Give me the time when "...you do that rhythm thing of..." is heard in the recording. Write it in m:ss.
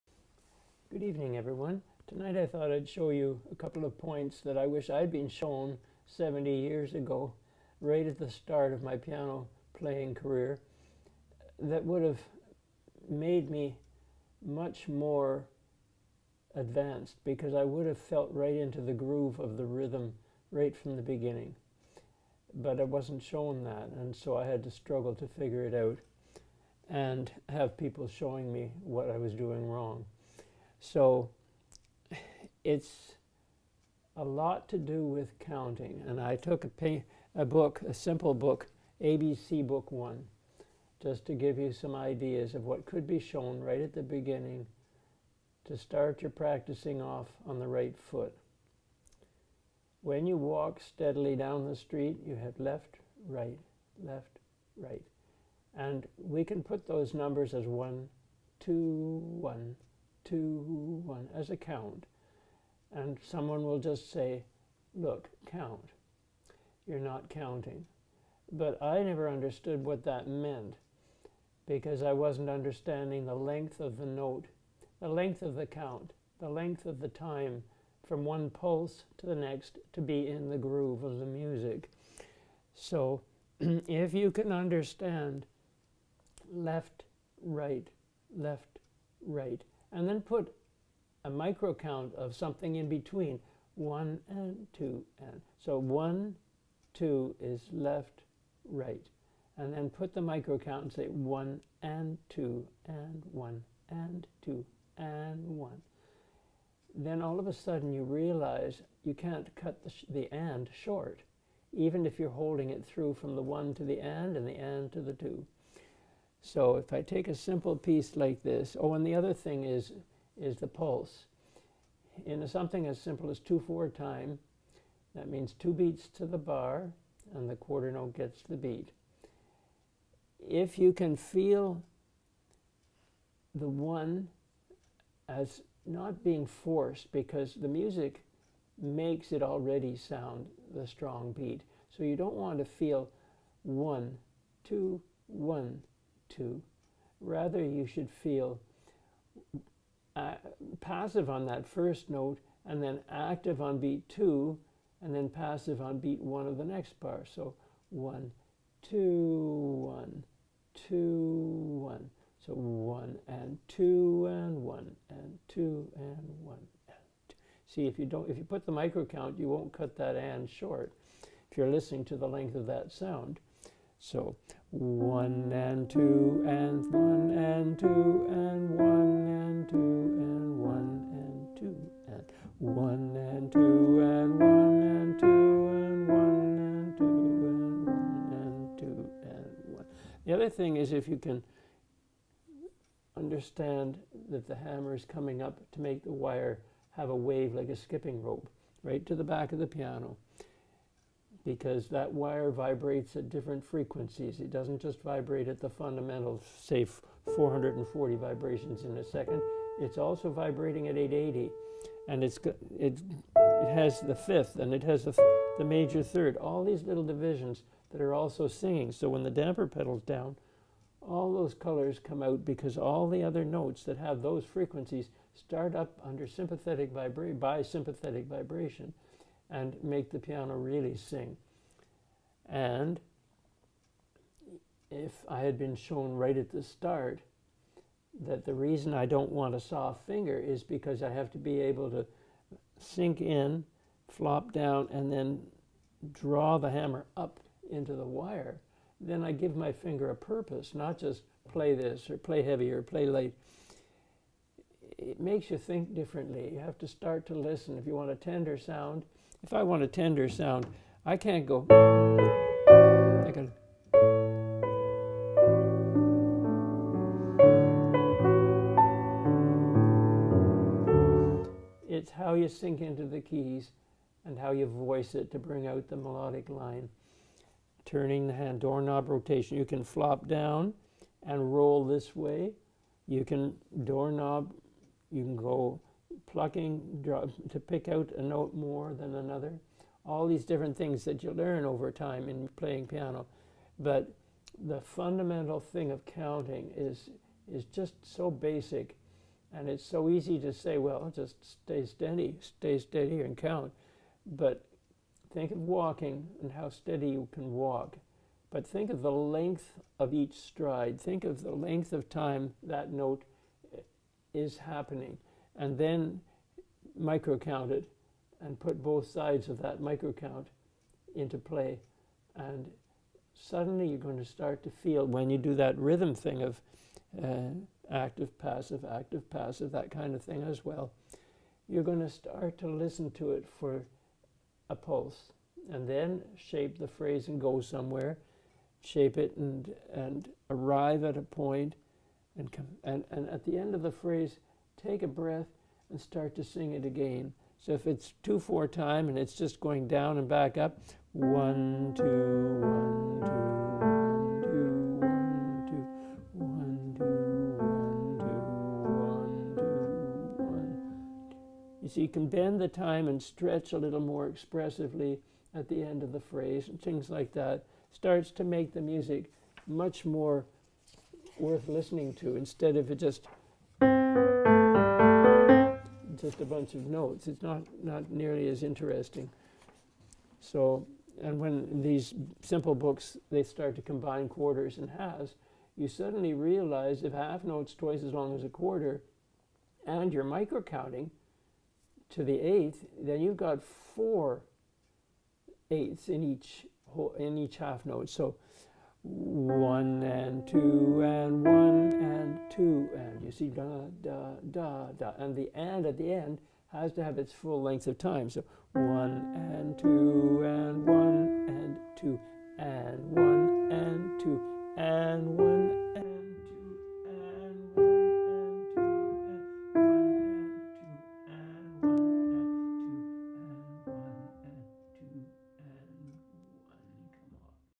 5:25.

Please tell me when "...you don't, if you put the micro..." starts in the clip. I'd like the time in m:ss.
2:47.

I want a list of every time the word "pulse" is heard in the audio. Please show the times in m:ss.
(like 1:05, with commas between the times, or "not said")
1:18, 2:00, 5:34.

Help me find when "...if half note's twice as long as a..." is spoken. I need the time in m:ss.
6:27.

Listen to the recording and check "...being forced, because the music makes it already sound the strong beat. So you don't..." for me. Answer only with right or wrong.
right.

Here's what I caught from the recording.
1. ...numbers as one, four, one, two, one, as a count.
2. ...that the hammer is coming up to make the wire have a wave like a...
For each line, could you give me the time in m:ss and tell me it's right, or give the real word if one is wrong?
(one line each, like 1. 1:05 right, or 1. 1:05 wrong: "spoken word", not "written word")
1. 0:57 wrong: "two", not "four"
2. 3:14 right.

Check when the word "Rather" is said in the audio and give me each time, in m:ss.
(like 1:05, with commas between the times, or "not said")
2:27.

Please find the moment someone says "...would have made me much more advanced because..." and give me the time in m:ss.
0:11.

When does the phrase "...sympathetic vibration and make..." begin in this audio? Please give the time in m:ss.
3:47.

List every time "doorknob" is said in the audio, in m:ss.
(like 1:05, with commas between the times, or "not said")
4:38, 4:43.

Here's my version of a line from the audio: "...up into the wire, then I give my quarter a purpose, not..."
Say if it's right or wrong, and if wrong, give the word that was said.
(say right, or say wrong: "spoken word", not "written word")
wrong: "finger", not "quarter".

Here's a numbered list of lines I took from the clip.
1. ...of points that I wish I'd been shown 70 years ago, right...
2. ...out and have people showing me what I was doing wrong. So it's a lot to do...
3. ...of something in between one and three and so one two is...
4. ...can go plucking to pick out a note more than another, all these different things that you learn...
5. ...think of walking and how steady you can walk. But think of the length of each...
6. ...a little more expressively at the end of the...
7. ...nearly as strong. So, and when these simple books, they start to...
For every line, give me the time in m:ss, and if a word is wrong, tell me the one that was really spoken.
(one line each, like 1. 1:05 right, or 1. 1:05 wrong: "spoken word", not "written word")
1. 0:03 right
2. 0:25 right
3. 1:32 wrong: "two", not "three"
4. 4:45 right
5. 5:05 right
6. 6:03 right
7. 6:18 wrong: "interesting", not "strong".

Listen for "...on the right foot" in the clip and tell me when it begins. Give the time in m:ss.
0:47.